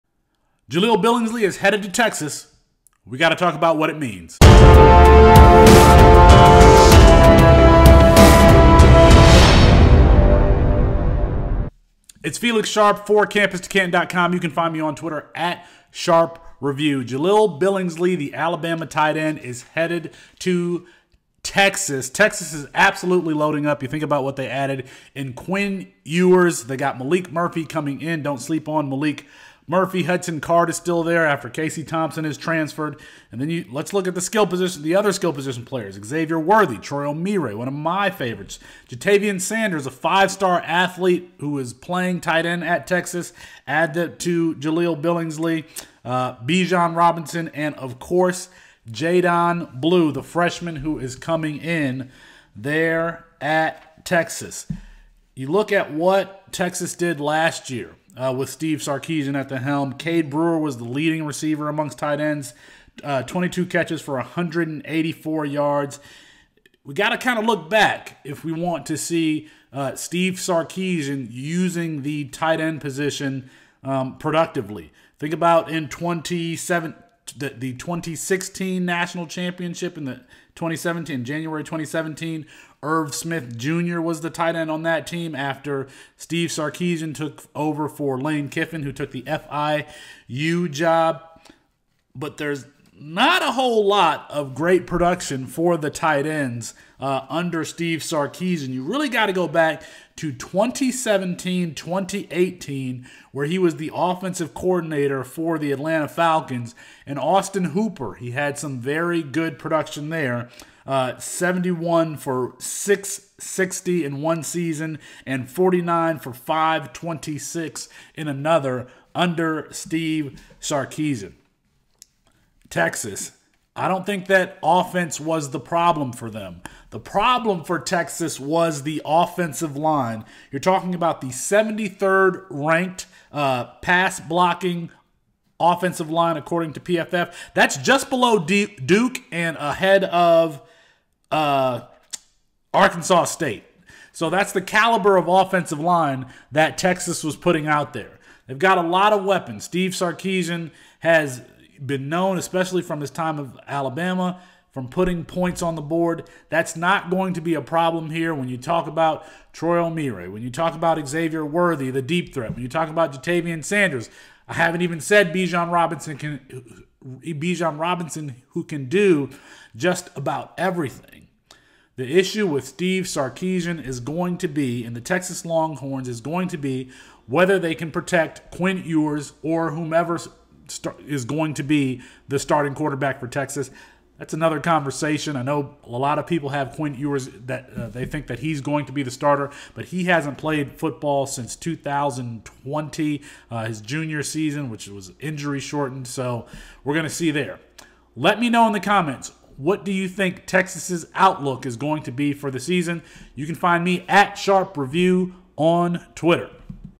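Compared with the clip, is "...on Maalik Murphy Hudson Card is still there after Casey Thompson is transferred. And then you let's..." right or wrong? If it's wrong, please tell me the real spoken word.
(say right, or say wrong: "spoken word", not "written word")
right.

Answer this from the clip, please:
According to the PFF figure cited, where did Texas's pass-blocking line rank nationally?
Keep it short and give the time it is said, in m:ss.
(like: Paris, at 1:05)
73rd, at 2:11.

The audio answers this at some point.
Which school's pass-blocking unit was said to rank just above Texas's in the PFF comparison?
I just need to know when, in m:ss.
2:18.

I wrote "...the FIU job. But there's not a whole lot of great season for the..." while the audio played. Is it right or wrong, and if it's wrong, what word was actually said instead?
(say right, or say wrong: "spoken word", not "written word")
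wrong: "production", not "season".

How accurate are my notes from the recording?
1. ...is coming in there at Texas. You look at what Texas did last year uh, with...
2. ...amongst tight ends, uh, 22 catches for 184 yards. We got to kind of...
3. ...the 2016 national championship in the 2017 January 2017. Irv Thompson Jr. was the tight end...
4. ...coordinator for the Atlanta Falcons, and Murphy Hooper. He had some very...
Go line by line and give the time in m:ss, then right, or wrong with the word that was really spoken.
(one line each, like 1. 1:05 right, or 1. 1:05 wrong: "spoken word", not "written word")
1. 0:50 right
2. 1:01 right
3. 1:17 wrong: "Smith", not "Thompson"
4. 1:44 wrong: "Austin", not "Murphy".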